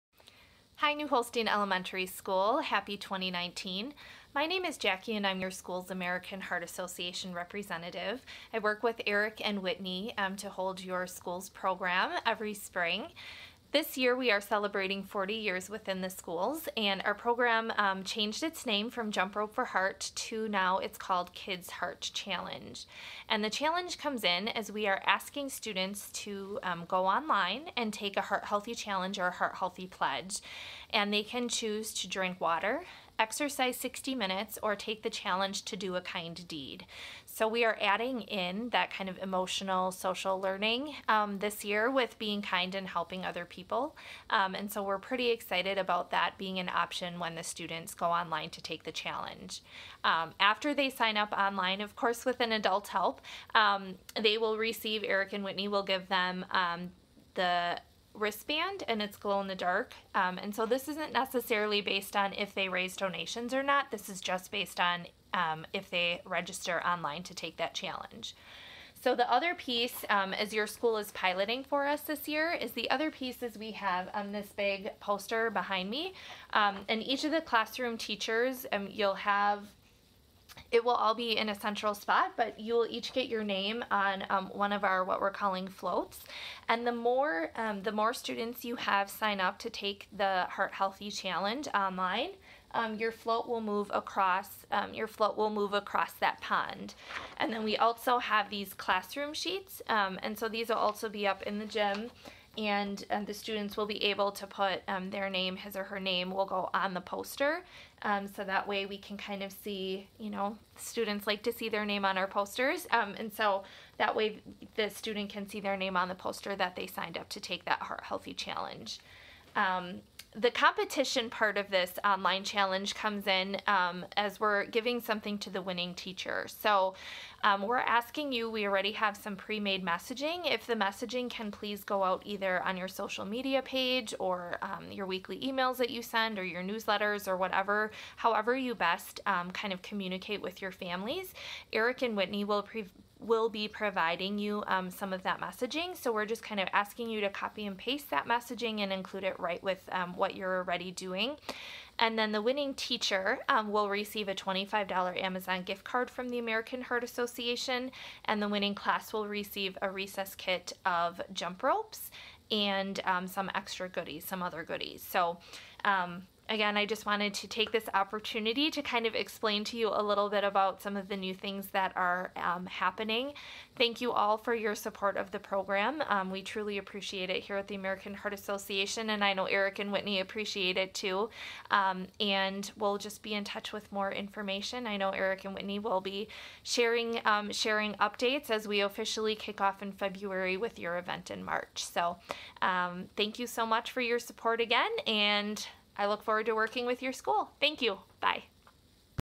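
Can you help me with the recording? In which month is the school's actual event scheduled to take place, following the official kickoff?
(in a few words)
March.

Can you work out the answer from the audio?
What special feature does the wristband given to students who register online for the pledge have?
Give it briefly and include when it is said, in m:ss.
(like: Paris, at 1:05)
Glow in the dark, at 0:59.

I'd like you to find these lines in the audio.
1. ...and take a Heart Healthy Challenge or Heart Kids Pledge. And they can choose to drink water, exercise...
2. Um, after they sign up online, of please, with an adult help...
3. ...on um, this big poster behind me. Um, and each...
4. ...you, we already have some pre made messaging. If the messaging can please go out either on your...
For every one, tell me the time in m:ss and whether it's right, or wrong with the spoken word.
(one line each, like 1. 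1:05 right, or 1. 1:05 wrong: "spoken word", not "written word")
1. 0:27 wrong: "Healthy", not "Kids"
2. 0:50 wrong: "course", not "please"
3. 1:14 right
4. 2:08 right.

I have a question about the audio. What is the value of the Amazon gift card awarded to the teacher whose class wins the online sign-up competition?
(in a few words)
$25.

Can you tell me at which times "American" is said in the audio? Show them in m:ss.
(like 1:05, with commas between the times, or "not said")
0:05, 2:36, 2:57.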